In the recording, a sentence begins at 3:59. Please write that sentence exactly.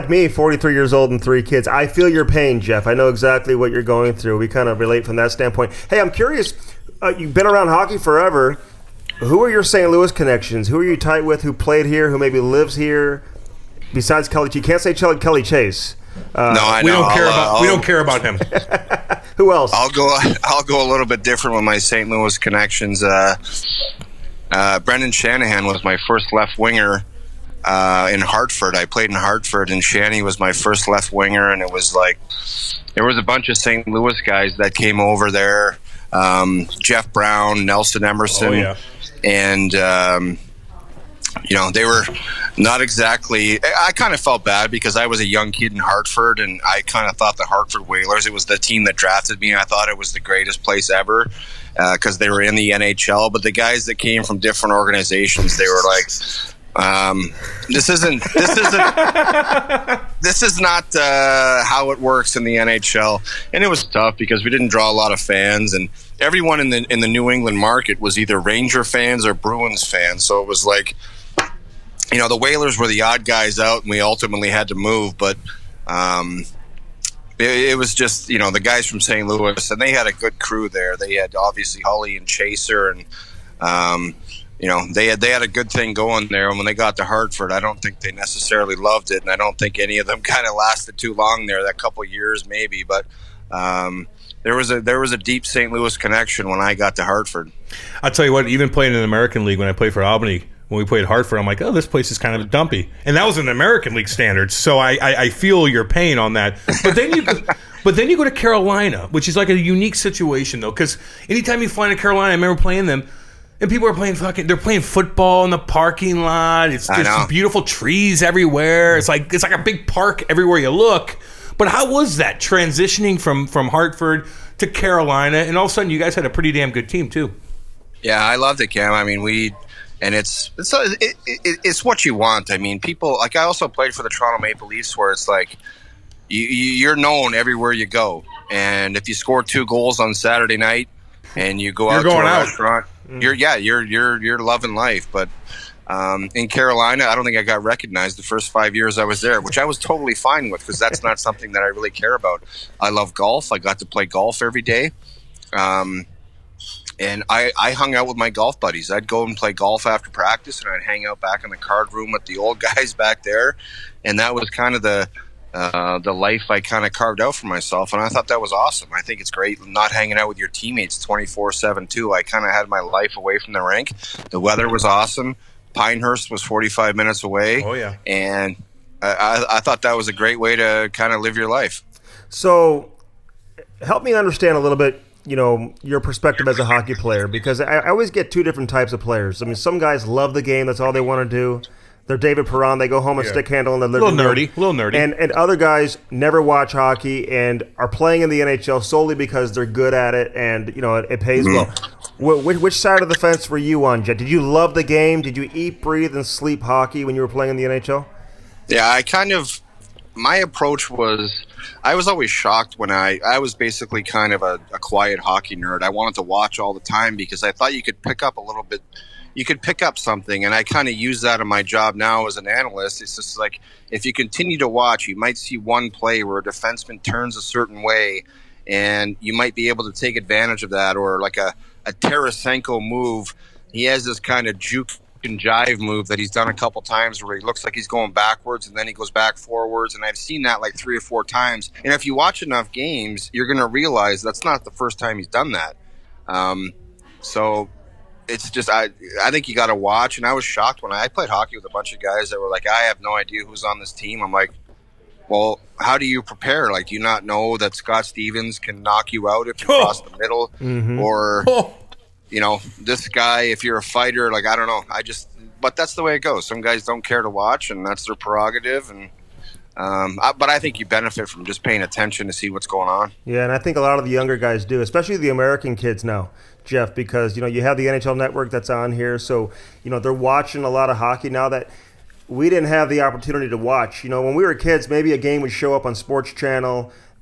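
And I've seen that like three or four times.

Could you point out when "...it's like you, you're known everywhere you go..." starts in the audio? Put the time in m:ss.
2:15.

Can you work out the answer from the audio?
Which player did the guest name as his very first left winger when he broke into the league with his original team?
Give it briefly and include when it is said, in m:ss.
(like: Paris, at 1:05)
Brendan Shanahan, at 0:24.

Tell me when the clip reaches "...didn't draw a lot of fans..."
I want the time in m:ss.
1:04.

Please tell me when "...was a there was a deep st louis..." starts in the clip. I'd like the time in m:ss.
1:34.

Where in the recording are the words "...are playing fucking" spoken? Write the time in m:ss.
1:53.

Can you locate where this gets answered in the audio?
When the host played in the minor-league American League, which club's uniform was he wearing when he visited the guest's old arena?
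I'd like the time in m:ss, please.
1:40.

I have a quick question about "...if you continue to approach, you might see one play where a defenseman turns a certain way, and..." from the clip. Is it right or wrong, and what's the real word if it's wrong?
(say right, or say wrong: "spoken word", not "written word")
wrong: "watch", not "approach".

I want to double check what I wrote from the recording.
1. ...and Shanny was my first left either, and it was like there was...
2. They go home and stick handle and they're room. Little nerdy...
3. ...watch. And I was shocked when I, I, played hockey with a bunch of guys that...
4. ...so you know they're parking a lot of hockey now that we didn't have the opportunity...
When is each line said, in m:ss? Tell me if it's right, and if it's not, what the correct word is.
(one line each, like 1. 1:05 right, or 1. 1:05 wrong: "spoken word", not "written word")
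1. 0:29 wrong: "winger", not "either"
2. 3:12 right
3. 4:09 right
4. 4:39 wrong: "watching", not "parking".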